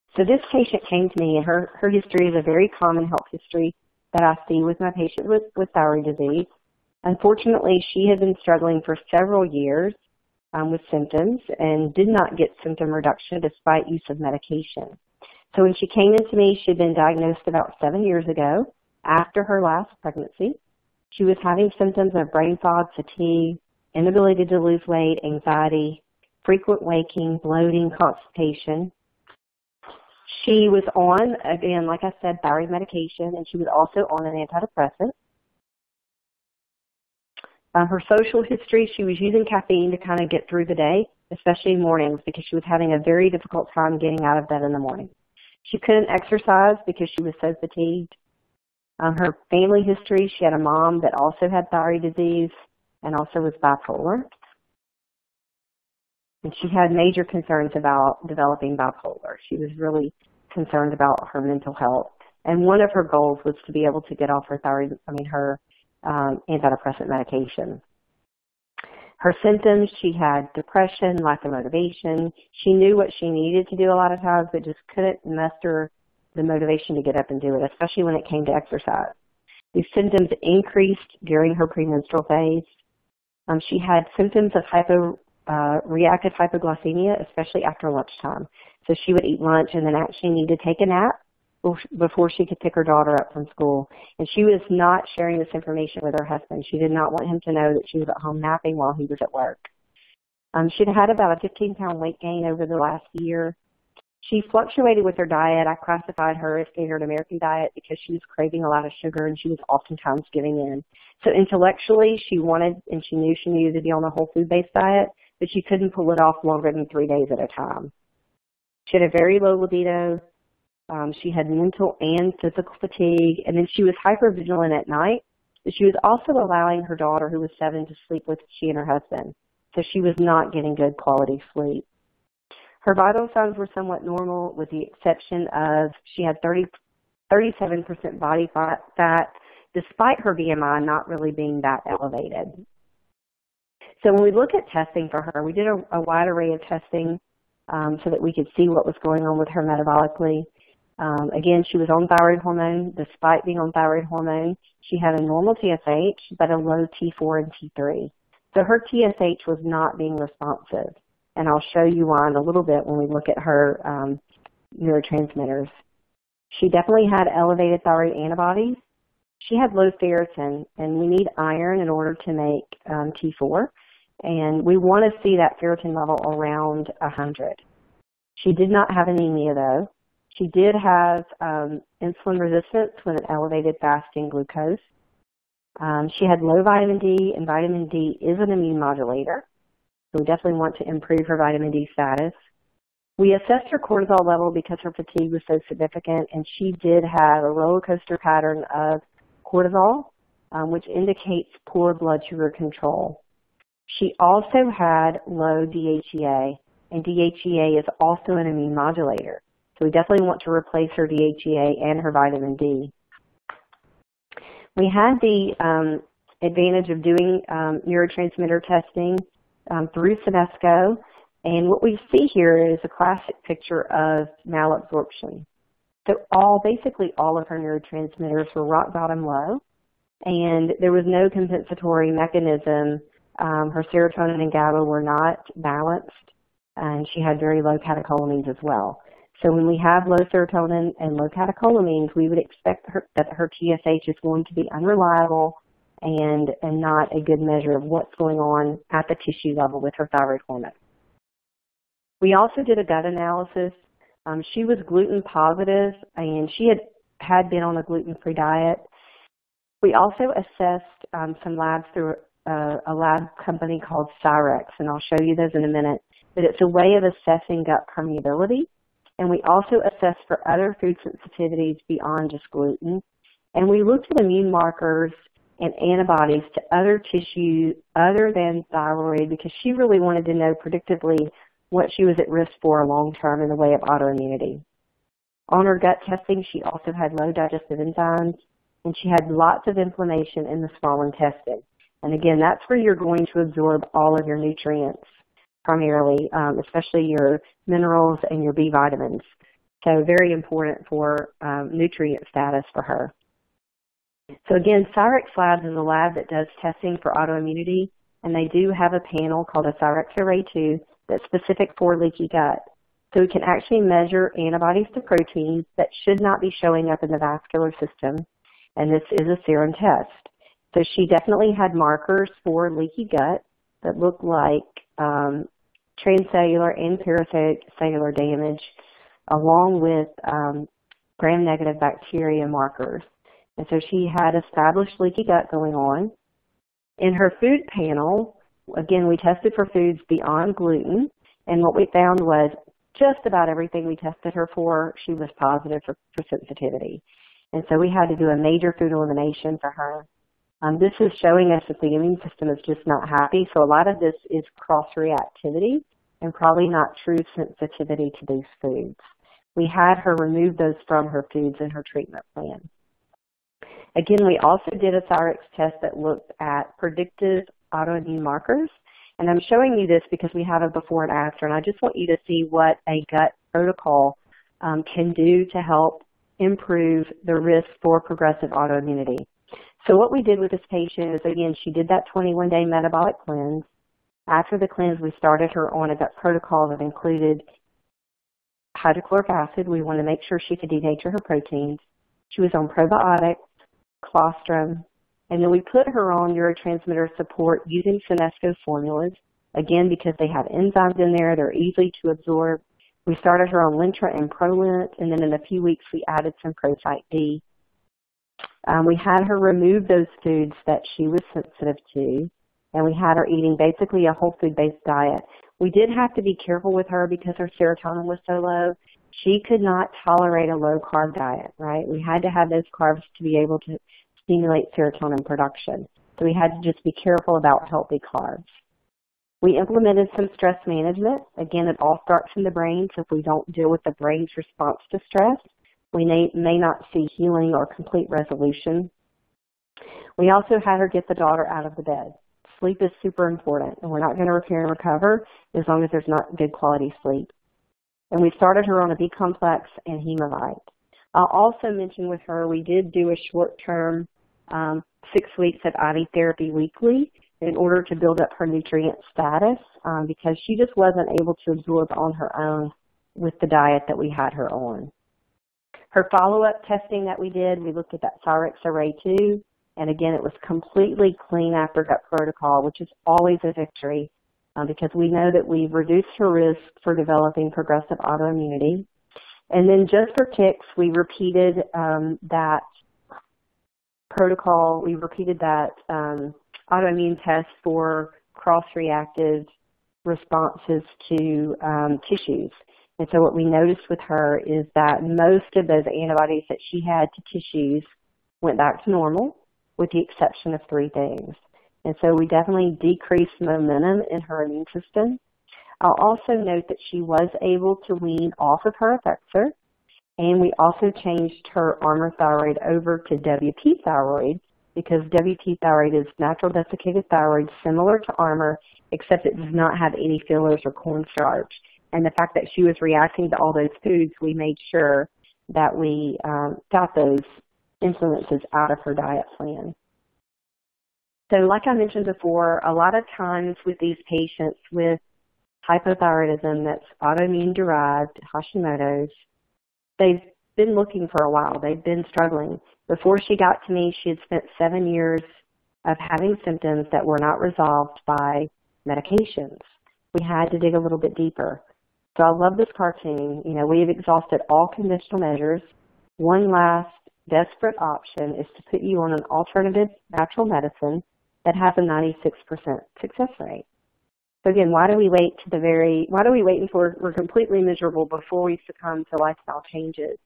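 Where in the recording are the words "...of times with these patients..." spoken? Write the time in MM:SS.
08:52.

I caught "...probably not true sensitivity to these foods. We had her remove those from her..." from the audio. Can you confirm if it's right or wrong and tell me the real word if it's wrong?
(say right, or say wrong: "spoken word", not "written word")
right.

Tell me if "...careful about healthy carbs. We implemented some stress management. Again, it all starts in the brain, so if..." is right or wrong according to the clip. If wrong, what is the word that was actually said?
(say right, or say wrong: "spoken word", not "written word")
right.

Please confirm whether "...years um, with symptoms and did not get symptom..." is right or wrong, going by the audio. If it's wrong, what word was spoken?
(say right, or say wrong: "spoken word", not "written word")
right.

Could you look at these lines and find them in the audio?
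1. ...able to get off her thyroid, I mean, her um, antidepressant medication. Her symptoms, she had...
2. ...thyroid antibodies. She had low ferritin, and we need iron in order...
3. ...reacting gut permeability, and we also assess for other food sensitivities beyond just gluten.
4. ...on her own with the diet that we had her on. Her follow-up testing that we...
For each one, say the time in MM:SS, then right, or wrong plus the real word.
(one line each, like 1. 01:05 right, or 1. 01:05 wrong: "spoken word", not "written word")
1. 01:03 right
2. 02:47 right
3. 04:27 wrong: "assessing", not "reacting"
4. 07:41 right.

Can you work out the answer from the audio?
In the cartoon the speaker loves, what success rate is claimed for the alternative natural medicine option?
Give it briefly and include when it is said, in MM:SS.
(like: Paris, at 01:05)
96%, at 09:21.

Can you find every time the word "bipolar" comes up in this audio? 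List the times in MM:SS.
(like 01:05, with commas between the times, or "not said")
00:53, 00:58.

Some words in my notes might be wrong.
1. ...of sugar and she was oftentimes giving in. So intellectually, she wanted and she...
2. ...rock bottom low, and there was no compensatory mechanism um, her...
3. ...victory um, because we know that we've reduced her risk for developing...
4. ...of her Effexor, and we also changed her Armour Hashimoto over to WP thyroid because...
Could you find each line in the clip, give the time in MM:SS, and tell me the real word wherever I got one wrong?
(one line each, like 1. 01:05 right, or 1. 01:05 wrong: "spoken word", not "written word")
1. 01:48 right
2. 03:48 right
3. 07:53 right
4. 08:28 wrong: "Thyroid", not "Hashimoto".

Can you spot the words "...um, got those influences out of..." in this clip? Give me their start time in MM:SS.
08:46.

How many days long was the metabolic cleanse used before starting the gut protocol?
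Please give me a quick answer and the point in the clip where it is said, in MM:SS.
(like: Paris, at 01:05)
21, at 06:22.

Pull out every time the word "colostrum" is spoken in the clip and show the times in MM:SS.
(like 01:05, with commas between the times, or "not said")
06:34.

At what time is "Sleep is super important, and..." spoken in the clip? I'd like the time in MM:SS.
07:22.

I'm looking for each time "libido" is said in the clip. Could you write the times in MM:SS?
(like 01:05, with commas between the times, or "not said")
01:59.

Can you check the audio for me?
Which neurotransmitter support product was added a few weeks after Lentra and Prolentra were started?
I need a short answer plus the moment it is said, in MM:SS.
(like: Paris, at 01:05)
Prosite D, at 06:46.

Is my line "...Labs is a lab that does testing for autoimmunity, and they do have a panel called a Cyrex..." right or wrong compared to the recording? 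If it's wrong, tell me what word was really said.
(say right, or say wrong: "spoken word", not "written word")
right.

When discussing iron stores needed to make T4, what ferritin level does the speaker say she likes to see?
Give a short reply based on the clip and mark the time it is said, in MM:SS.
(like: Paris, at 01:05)
100, at 02:56.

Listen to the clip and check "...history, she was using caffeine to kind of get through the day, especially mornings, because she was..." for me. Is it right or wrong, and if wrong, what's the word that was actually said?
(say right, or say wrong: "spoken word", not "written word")
right.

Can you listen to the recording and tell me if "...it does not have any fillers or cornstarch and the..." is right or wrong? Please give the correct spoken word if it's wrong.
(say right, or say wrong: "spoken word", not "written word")
right.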